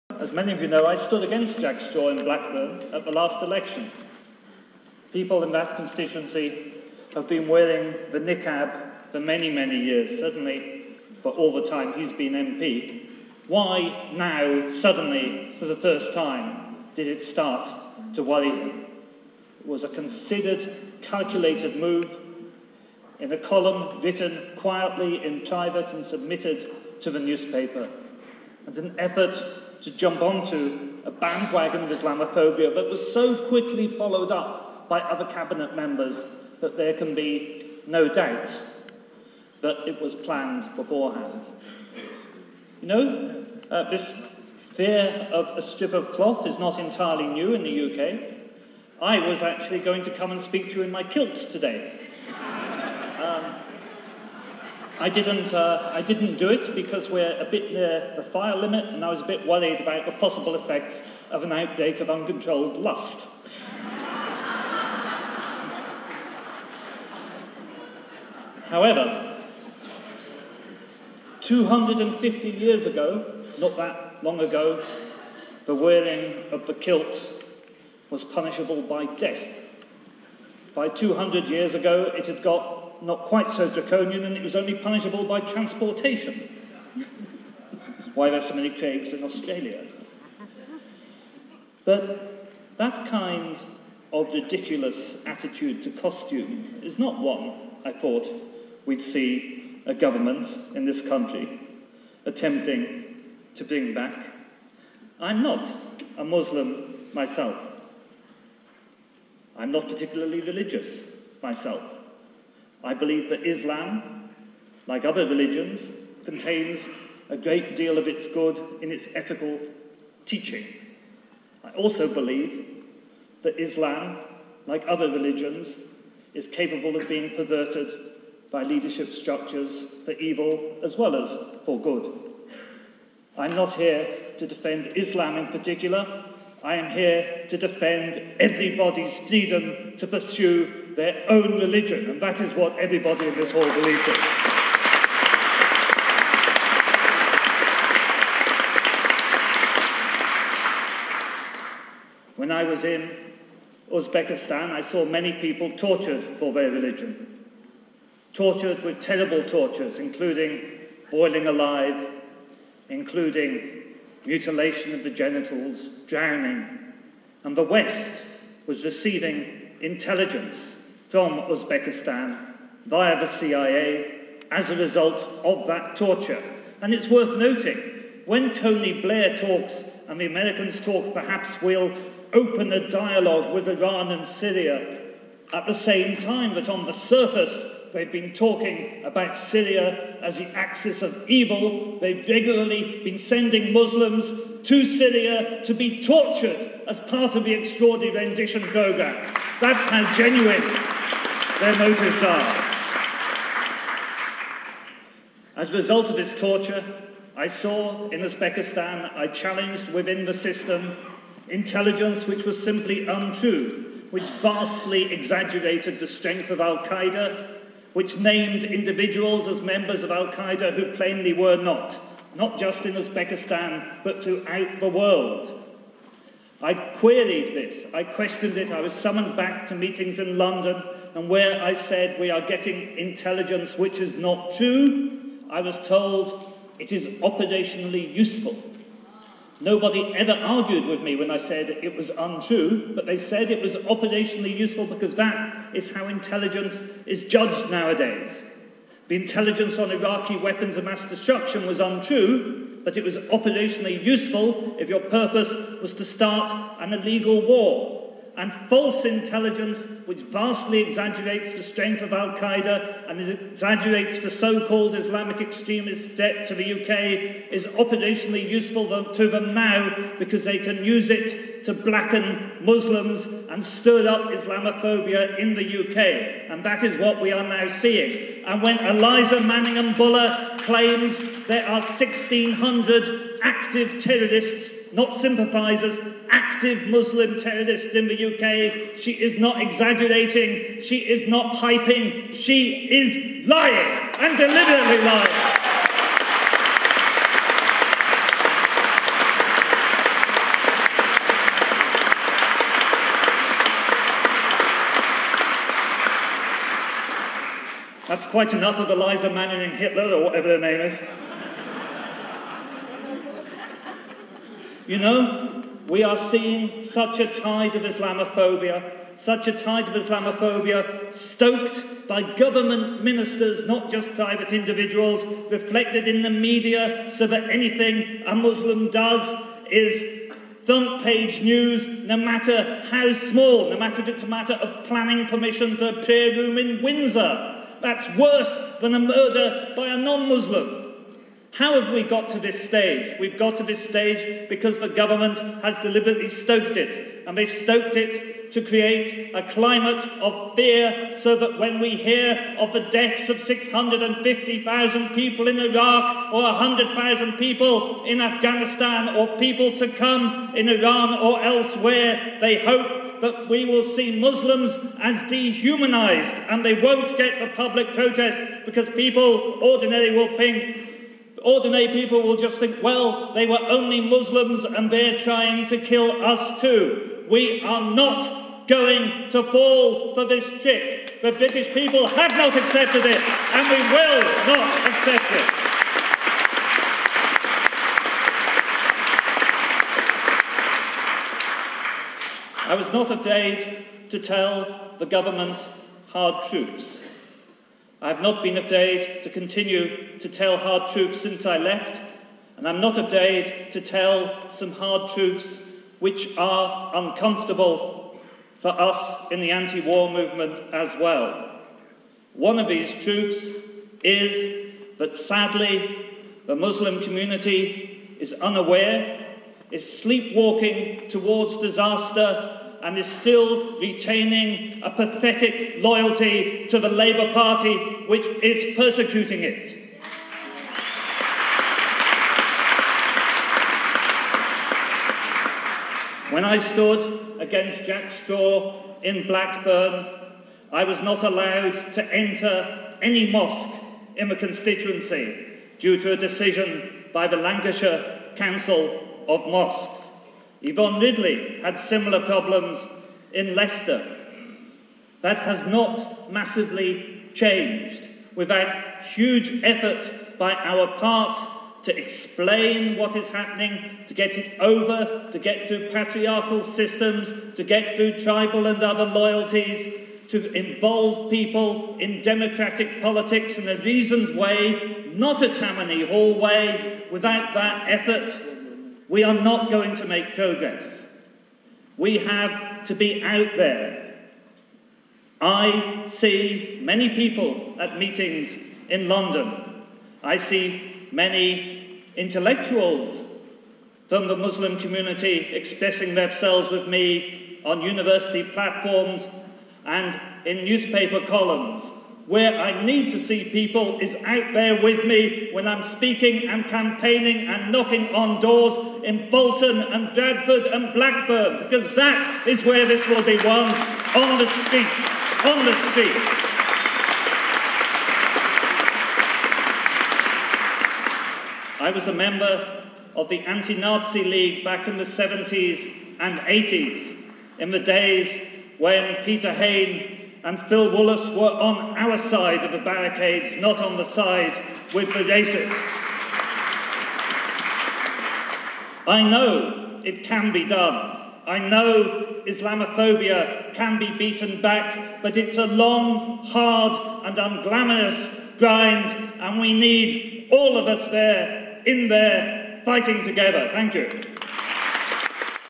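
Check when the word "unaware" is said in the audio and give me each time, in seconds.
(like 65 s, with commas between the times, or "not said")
418 s.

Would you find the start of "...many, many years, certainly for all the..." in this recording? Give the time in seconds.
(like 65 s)
9 s.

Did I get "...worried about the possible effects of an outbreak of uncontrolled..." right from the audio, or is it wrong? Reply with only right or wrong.
right.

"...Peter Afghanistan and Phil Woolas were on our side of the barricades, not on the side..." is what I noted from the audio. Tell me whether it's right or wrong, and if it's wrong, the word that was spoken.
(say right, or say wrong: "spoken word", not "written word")
wrong: "Hain", not "Afghanistan".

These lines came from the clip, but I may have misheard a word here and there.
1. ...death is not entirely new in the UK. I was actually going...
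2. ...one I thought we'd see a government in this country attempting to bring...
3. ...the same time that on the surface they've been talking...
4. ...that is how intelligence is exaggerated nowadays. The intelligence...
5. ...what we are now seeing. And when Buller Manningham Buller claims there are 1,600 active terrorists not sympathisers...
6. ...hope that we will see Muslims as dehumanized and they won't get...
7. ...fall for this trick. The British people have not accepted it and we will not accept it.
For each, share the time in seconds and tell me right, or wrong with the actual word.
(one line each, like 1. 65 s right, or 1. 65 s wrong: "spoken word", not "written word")
1. 46 s wrong: "cloth", not "death"
2. 97 s right
3. 185 s right
4. 245 s wrong: "judged", not "exaggerated"
5. 276 s wrong: "Eliza", not "Buller"
6. 362 s right
7. 379 s right.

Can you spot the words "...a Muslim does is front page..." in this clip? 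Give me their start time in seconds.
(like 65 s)
328 s.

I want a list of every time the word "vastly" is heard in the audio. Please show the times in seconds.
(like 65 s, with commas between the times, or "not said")
214 s, 260 s.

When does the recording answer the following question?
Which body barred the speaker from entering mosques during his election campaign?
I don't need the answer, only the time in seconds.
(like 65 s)
447 s.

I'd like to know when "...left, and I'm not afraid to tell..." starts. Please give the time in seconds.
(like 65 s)
401 s.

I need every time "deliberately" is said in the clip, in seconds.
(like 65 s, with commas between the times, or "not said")
294 s, 345 s.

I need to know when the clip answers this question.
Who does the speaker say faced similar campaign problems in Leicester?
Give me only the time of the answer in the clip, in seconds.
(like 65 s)
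450 s.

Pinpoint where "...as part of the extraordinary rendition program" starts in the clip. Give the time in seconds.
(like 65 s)
196 s.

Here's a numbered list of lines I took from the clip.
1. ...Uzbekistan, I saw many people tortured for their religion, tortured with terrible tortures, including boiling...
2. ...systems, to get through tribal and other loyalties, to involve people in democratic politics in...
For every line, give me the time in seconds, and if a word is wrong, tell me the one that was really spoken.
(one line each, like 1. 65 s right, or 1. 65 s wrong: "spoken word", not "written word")
1. 153 s right
2. 466 s right.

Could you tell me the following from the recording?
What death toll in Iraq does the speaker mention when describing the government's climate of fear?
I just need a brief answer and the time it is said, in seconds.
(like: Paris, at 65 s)
650,000, at 353 s.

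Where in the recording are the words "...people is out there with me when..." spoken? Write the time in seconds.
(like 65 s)
503 s.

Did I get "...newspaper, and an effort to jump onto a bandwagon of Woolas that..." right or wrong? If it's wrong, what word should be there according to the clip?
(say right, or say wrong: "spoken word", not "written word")
wrong: "Islamophobia", not "Woolas".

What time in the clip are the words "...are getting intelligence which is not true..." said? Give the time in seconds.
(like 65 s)
232 s.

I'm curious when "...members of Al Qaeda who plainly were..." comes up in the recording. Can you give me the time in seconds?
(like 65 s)
219 s.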